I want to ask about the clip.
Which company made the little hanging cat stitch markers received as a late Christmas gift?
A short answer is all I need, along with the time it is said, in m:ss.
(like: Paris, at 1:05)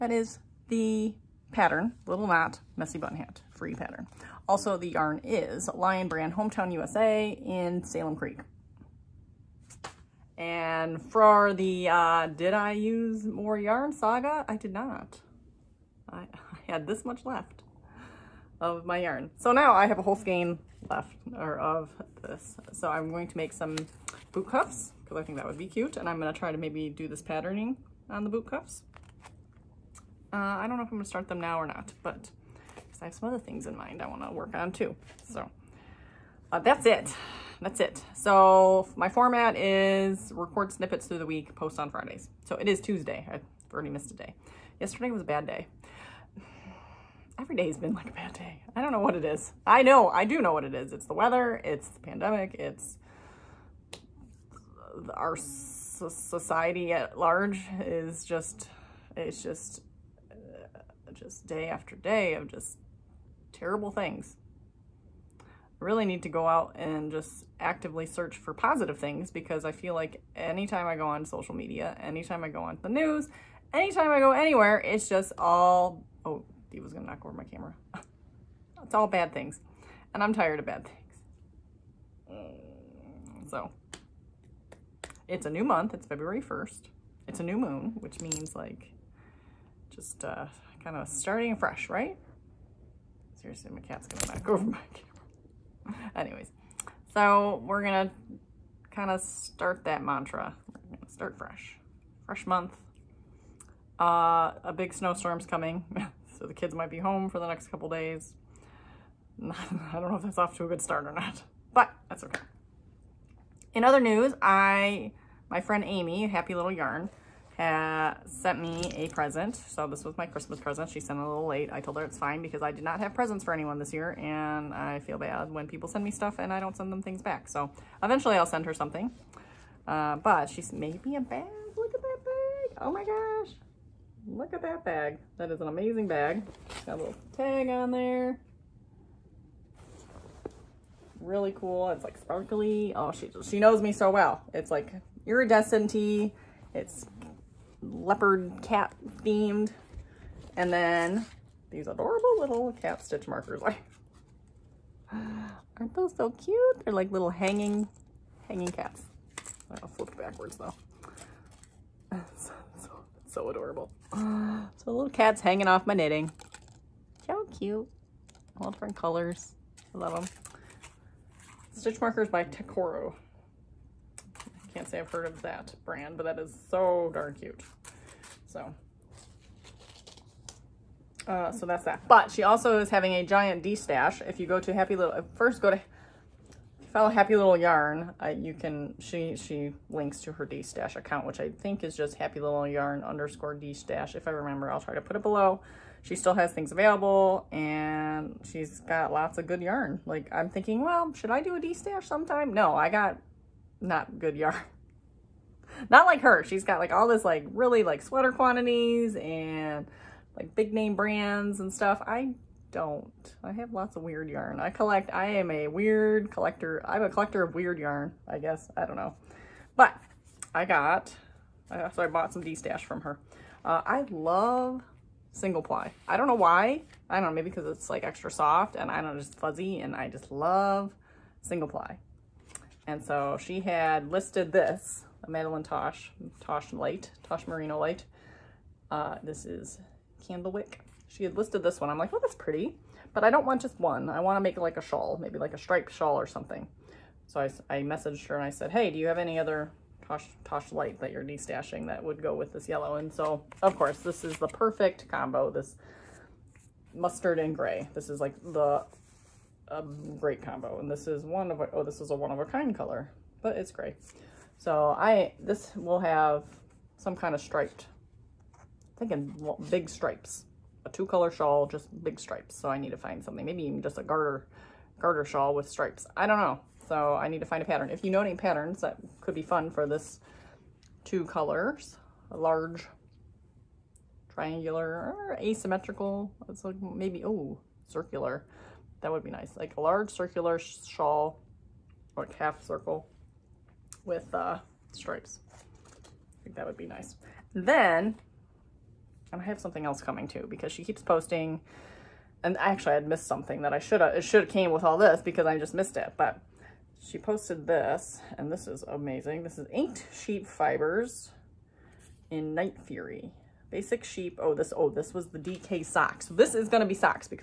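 Tekoro, at 2:52.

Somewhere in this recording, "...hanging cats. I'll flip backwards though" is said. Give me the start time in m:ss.
2:38.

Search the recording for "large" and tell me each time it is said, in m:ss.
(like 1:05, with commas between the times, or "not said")
0:57, 4:42, 4:49.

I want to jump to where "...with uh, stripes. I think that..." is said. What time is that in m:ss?
4:54.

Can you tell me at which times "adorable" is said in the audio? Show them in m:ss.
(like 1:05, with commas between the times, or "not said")
2:31, 2:43.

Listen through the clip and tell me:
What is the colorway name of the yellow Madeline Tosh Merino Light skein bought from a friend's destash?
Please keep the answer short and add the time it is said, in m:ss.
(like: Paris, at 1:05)
Candlewick, at 4:00.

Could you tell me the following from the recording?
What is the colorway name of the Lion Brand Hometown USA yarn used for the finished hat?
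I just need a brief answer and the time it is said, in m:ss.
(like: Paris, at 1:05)
Salem Creek, at 0:07.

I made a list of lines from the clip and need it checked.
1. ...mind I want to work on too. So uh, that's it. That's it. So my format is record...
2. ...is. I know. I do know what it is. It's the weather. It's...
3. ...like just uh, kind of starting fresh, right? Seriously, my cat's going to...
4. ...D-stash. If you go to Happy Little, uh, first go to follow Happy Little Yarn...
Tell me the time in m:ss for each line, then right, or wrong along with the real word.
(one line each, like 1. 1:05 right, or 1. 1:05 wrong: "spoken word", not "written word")
1. 0:33 right
2. 0:49 right
3. 1:28 right
4. 3:03 right.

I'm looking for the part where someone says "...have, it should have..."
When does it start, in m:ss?
5:04.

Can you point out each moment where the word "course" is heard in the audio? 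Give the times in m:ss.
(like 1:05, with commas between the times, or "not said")
4:13.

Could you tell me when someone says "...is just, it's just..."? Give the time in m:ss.
0:57.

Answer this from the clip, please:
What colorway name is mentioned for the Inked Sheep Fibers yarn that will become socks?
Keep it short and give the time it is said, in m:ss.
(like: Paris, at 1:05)
Night Fury, at 5:12.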